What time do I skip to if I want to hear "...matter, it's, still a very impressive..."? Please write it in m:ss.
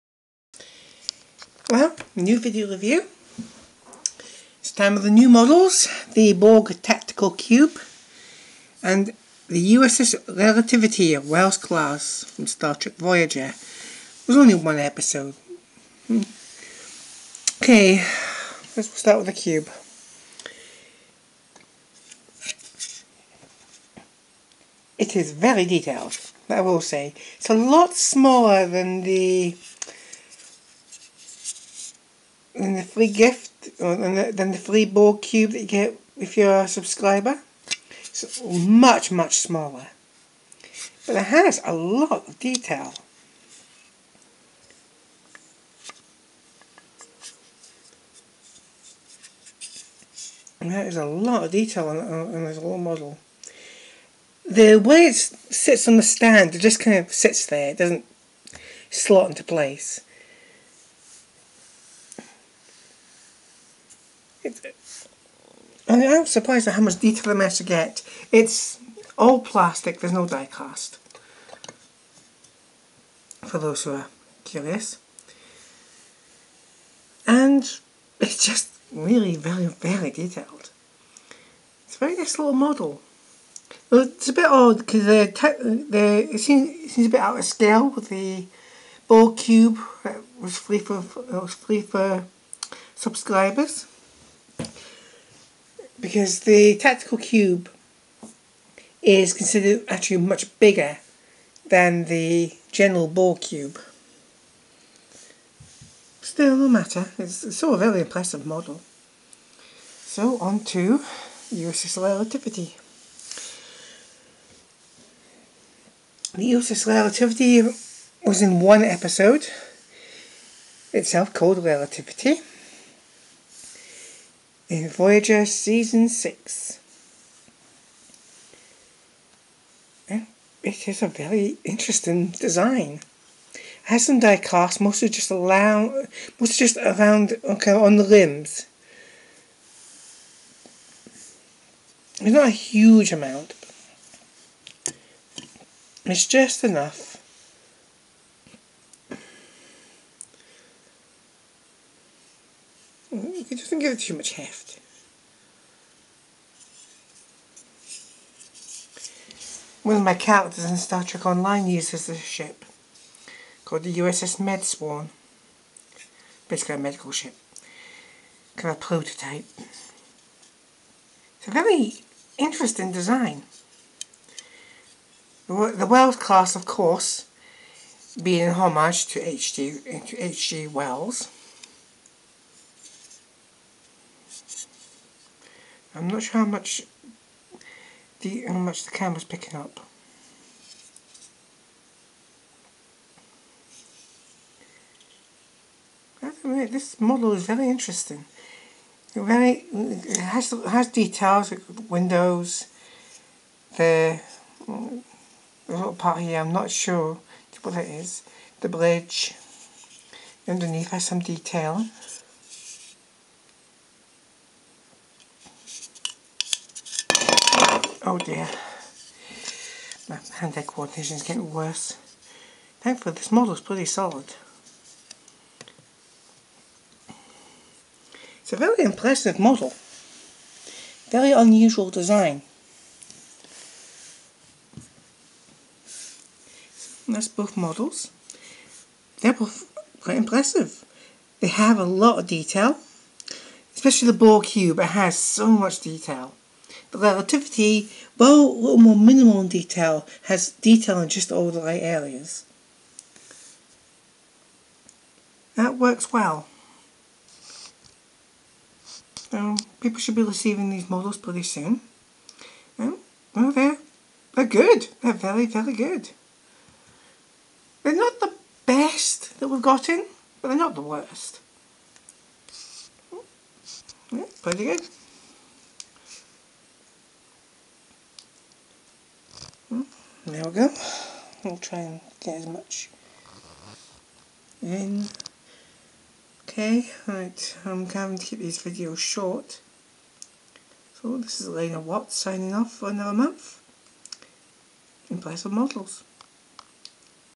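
1:46.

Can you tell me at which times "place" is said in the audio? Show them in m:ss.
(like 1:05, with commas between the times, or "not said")
0:59, 4:55.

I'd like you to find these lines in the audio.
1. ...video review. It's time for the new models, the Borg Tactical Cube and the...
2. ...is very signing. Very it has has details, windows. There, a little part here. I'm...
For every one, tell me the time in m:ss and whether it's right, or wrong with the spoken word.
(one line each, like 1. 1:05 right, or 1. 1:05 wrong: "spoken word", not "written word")
1. 0:02 right
2. 3:17 wrong: "interesting", not "signing".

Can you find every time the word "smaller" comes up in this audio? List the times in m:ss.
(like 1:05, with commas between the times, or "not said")
0:27, 0:39.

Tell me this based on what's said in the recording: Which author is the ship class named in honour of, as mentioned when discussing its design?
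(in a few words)
H.G. Wells.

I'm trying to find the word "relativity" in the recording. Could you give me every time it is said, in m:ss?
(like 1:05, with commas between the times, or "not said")
0:10, 1:52, 1:56, 2:01, 4:06.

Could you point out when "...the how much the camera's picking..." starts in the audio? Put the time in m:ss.
3:08.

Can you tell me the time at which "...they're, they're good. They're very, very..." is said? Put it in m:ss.
4:23.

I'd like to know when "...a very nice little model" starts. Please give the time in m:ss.
1:21.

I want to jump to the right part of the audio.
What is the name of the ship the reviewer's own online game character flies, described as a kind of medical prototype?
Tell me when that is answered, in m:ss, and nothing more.
2:43.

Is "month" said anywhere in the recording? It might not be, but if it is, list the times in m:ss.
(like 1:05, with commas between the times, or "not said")
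4:53.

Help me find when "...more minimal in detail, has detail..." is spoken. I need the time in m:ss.
4:08.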